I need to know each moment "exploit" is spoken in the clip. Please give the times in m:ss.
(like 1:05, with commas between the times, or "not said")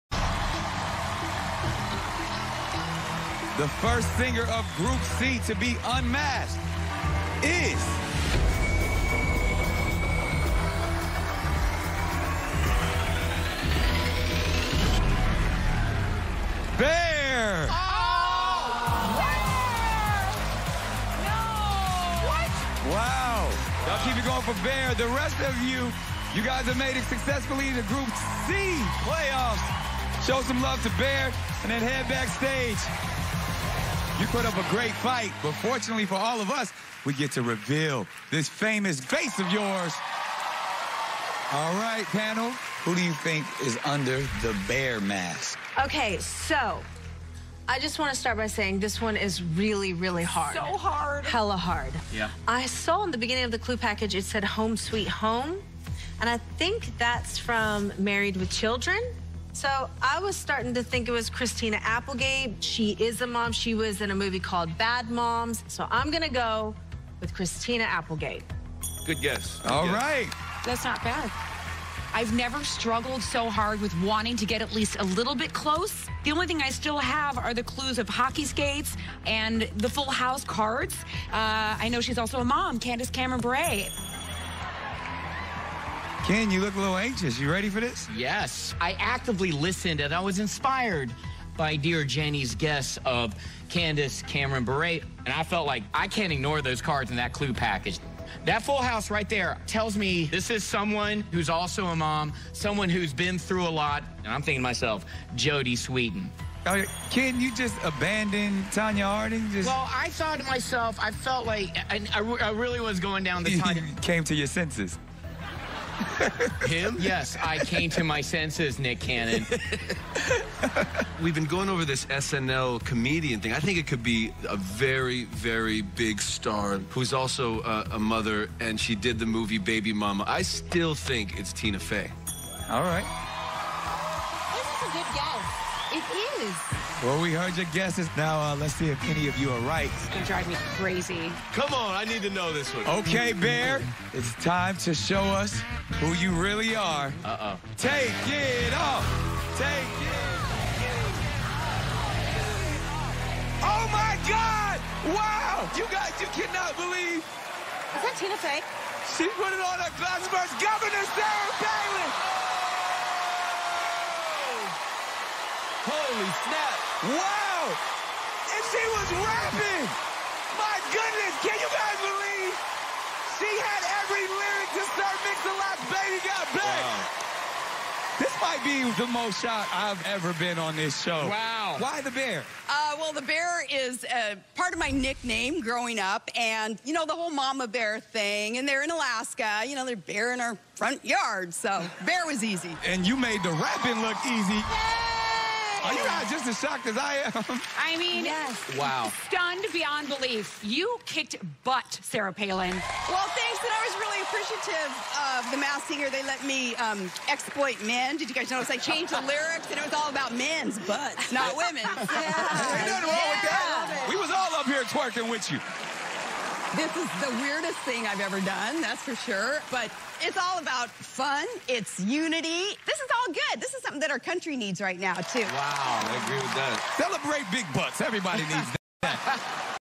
3:27.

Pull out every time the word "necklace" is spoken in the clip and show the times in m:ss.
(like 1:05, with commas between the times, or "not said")
not said.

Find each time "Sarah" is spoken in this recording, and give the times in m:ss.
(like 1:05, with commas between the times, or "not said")
2:41, 3:22.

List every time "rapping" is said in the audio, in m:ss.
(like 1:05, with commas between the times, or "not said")
2:49, 3:13.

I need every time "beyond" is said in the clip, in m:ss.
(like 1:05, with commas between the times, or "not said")
3:19.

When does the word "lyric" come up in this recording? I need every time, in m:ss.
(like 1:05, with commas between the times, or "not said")
2:54, 3:29.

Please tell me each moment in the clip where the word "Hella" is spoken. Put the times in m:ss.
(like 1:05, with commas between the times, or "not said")
0:51.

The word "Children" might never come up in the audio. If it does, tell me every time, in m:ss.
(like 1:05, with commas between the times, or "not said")
0:58.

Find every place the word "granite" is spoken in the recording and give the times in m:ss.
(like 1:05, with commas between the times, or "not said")
not said.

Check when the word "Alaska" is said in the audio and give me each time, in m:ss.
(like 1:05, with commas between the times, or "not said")
3:08.